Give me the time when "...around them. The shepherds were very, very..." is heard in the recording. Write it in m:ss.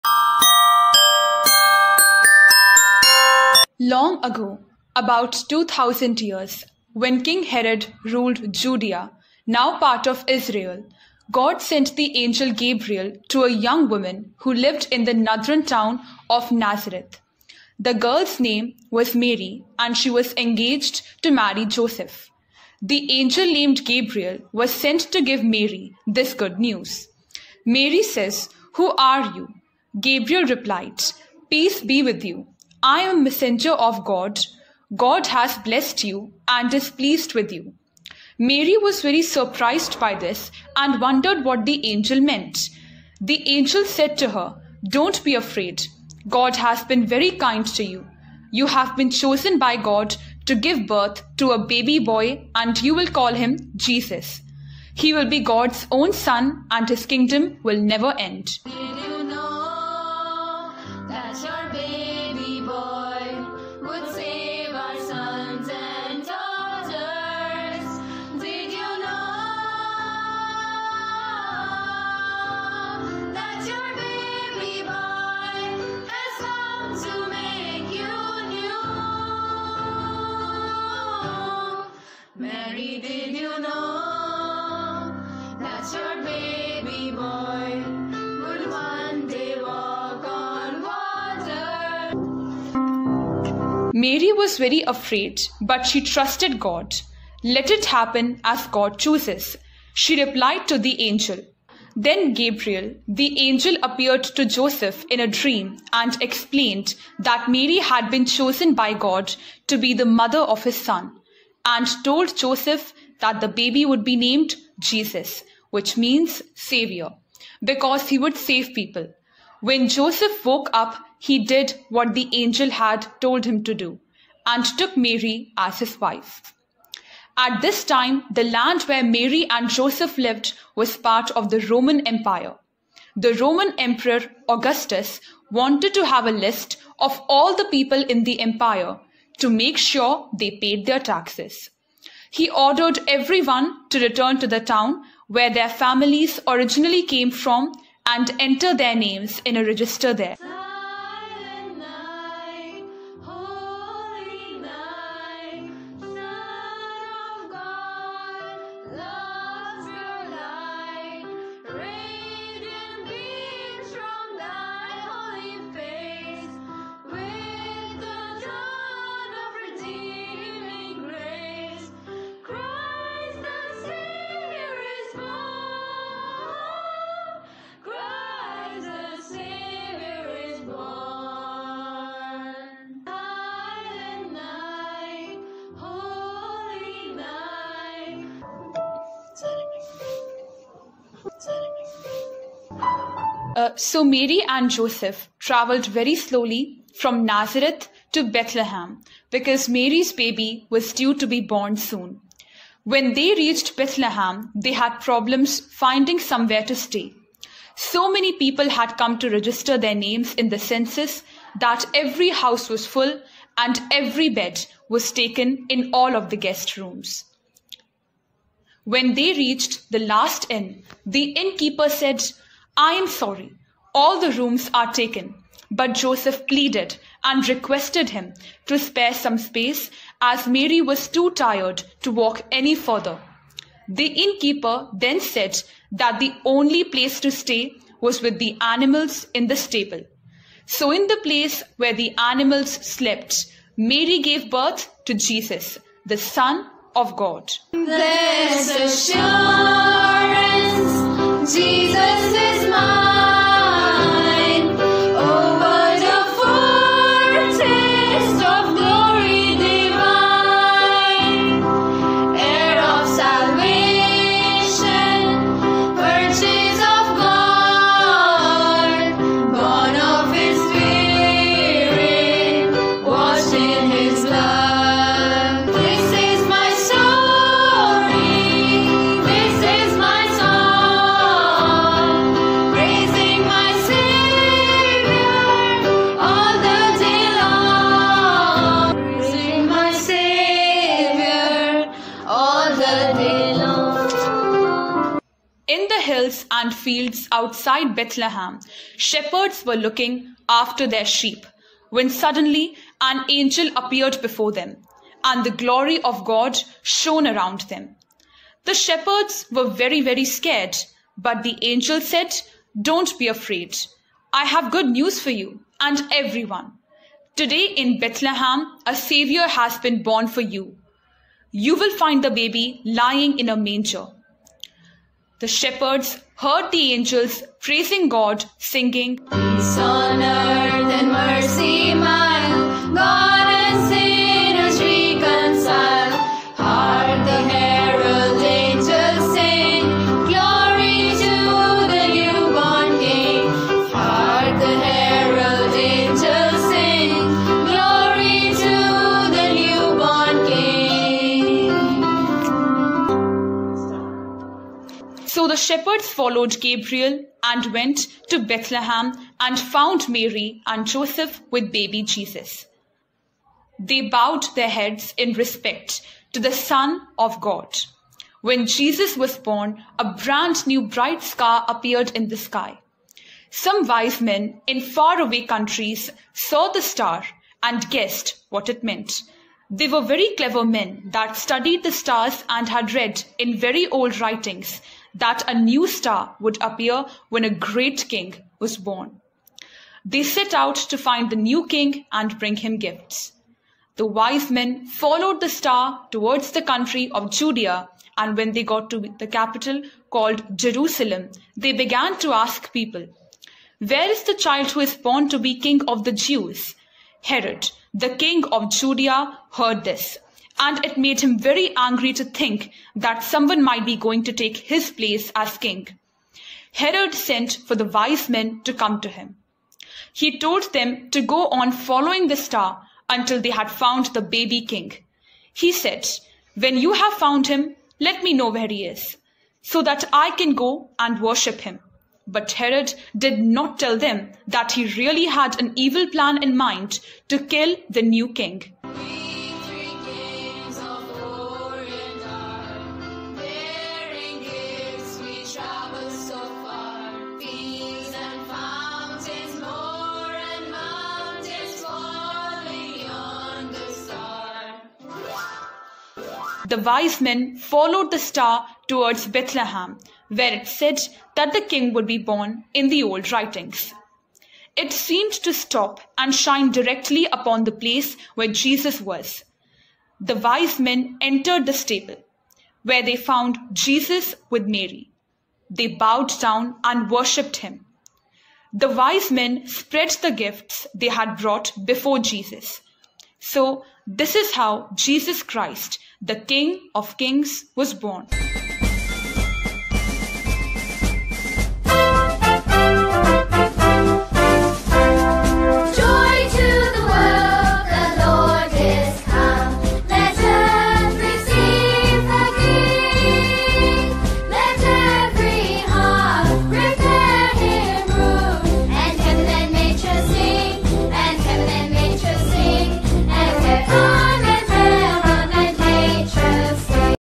5:07.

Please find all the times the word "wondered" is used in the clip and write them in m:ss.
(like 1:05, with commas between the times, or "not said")
0:40.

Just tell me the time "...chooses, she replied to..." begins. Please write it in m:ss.
1:38.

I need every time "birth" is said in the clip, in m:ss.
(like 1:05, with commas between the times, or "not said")
0:50, 4:04.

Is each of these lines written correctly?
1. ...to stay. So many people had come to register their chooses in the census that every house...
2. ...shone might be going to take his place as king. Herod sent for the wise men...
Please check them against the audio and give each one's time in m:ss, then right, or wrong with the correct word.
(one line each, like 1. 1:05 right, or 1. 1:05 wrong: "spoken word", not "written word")
1. 3:26 wrong: "names", not "chooses"
2. 6:53 wrong: "someone", not "shone".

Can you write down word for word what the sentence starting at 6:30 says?
They set out to find the new king and bring him gifts.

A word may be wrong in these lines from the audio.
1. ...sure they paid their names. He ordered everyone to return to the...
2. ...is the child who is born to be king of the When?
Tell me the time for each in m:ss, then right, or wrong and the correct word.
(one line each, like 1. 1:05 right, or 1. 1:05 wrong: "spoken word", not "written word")
1. 2:19 wrong: "taxes", not "names"
2. 6:44 wrong: "Jews", not "When".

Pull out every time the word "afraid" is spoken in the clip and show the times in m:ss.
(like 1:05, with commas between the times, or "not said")
0:45, 1:34, 5:13.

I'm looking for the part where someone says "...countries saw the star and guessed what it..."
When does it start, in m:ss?
6:15.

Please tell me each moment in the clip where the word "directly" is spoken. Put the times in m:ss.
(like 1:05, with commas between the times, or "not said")
7:46.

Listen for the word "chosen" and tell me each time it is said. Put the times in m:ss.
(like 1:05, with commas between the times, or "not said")
0:49, 1:48.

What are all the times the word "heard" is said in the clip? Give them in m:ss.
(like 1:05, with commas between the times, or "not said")
5:26, 6:49.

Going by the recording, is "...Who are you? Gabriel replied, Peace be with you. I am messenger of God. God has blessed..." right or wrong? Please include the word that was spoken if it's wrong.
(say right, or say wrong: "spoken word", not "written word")
right.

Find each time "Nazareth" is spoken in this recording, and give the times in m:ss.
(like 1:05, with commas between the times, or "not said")
0:16, 3:17.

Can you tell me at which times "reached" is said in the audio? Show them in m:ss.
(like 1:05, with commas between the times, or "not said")
3:23, 3:39.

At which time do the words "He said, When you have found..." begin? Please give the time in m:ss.
7:05.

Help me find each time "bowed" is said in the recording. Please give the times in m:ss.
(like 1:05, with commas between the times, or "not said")
6:04, 7:55.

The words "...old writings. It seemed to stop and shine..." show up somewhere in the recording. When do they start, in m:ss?
7:43.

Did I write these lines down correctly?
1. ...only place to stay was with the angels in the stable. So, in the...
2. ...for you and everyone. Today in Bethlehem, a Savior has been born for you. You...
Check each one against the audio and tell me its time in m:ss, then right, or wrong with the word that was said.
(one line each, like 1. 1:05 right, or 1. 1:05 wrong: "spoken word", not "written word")
1. 3:56 wrong: "animals", not "angels"
2. 5:15 right.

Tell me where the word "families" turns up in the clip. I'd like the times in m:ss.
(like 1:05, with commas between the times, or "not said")
2:25.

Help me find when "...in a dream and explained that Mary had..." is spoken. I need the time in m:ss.
1:45.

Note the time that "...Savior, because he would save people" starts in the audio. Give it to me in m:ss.
1:56.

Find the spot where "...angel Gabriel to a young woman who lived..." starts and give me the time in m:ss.
0:12.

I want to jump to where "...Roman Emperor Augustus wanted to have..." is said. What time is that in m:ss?
2:13.